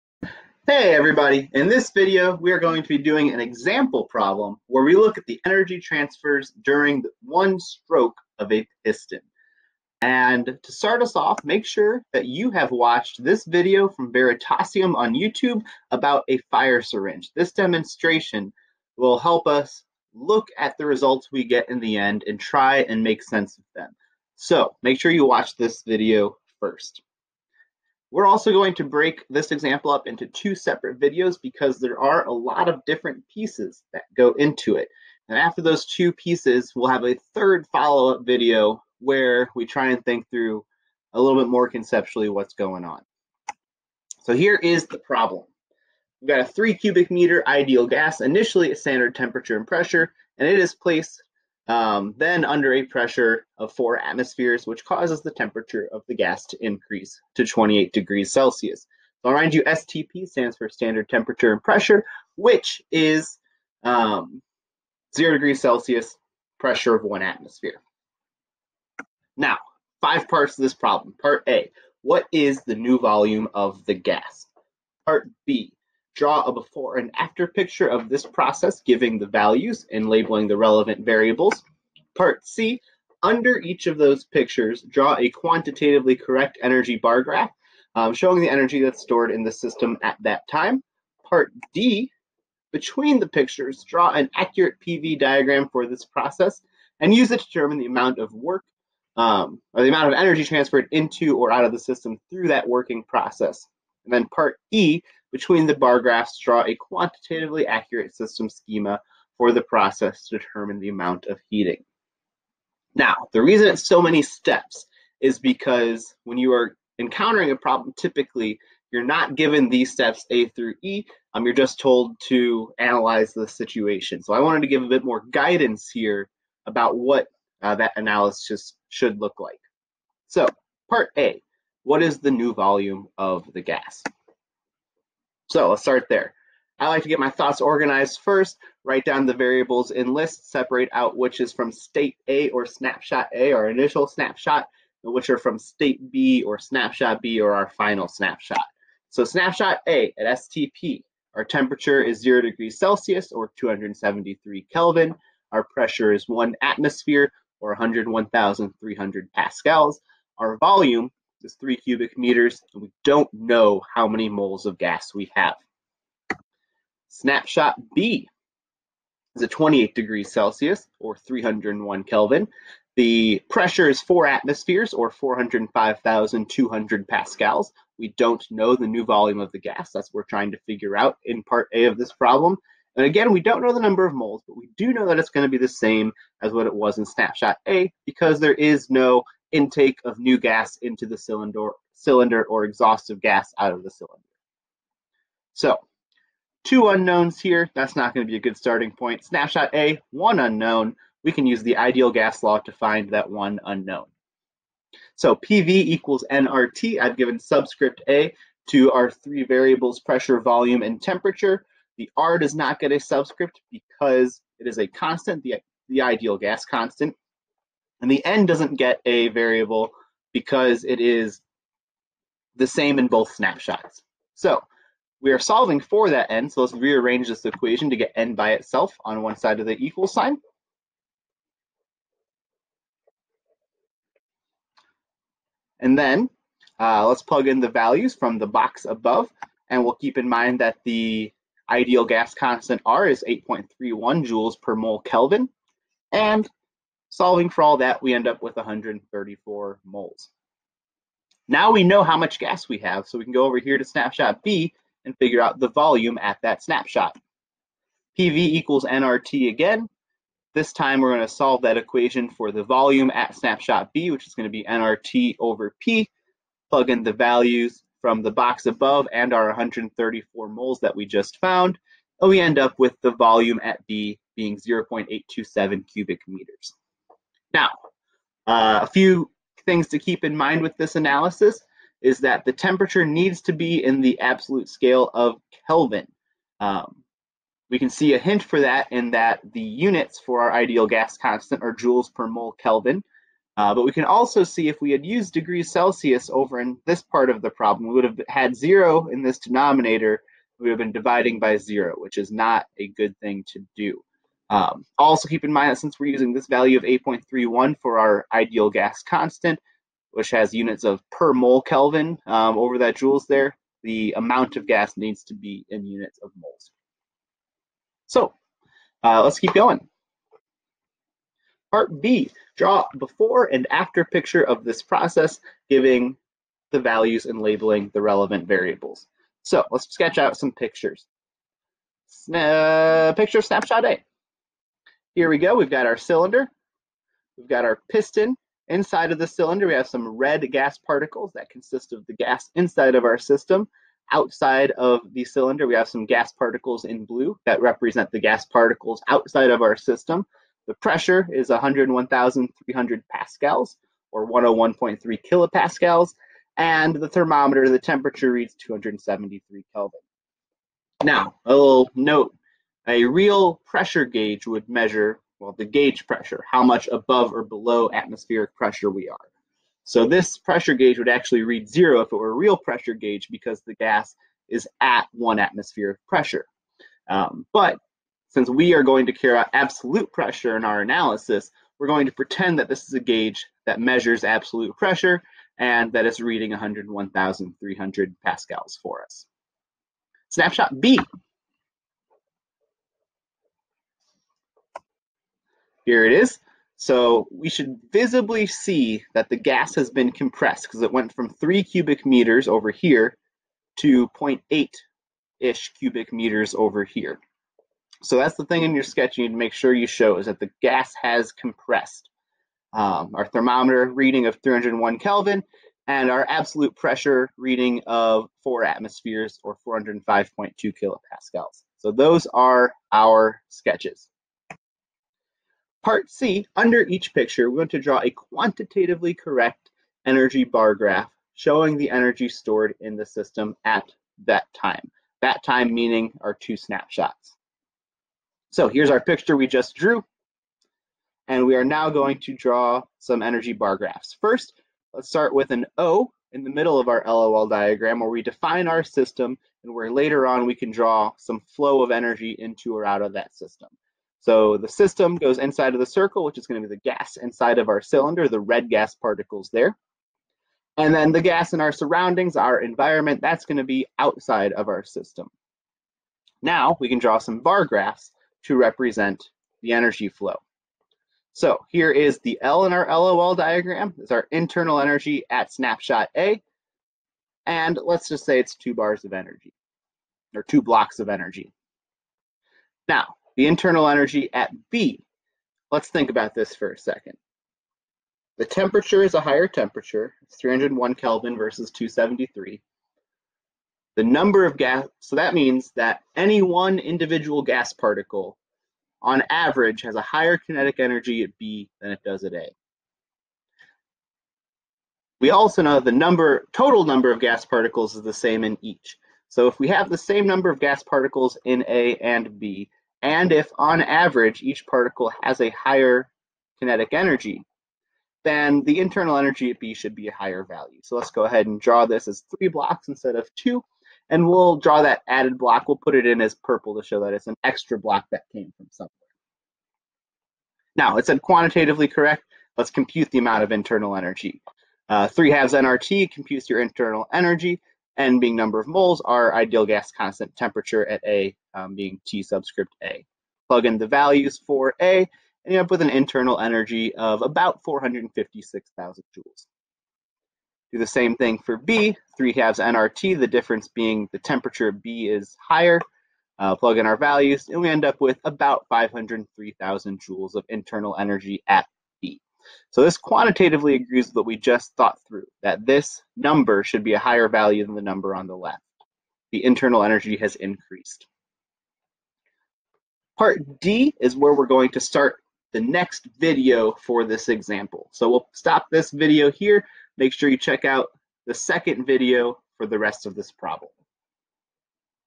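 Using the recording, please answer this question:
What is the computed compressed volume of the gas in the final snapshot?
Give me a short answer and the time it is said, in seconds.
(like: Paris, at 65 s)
0.827 cubic meters, at 274 s.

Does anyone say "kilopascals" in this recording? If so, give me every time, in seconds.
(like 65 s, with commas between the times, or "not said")
355 s, 420 s.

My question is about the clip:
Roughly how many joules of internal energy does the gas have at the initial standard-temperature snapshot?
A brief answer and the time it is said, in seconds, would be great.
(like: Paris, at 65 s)
456,000 joules, at 547 s.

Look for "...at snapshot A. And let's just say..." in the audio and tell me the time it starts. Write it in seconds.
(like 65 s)
475 s.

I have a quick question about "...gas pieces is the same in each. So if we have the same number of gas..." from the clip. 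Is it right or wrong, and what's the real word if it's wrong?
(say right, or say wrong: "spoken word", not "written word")
wrong: "particles", not "pieces".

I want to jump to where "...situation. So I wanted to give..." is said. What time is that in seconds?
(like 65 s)
123 s.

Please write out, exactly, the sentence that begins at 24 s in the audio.
So make sure you watch this video first.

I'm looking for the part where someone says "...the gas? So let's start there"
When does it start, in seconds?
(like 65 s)
133 s.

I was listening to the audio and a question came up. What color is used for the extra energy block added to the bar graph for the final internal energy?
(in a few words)
Purple.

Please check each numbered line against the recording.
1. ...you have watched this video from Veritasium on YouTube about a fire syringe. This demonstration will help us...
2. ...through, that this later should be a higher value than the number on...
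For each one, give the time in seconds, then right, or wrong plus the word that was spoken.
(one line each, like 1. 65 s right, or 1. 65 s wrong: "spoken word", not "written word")
1. 12 s right
2. 565 s wrong: "number", not "later".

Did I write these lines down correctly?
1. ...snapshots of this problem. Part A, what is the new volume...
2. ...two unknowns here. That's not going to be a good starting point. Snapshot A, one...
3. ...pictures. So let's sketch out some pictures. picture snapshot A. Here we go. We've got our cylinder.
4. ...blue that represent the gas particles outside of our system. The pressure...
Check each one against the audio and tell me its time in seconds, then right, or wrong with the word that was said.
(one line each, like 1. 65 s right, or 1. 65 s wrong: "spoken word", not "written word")
1. 70 s wrong: "parts", not "snapshots"
2. 196 s right
3. 328 s wrong: "variables", not "pictures"
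4. 347 s right.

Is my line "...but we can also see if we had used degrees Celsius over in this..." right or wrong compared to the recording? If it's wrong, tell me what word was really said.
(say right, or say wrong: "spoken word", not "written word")
right.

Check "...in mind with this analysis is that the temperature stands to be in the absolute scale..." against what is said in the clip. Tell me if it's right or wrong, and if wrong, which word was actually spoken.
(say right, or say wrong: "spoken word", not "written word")
wrong: "needs", not "stands".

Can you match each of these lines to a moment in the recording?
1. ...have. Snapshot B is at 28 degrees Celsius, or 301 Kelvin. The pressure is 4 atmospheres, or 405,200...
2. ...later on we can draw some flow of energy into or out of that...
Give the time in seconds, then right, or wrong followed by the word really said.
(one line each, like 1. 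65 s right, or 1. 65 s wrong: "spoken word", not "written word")
1. 165 s right
2. 449 s right.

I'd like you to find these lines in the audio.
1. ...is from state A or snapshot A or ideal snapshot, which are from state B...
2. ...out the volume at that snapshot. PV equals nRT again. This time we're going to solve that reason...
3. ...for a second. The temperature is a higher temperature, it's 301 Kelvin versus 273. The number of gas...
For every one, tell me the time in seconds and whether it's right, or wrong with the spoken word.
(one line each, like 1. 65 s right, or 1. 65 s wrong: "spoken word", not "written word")
1. 141 s wrong: "initial", not "ideal"
2. 255 s wrong: "equation", not "reason"
3. 486 s right.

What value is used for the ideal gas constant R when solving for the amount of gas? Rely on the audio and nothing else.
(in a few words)
8.31 joules per mole Kelvin.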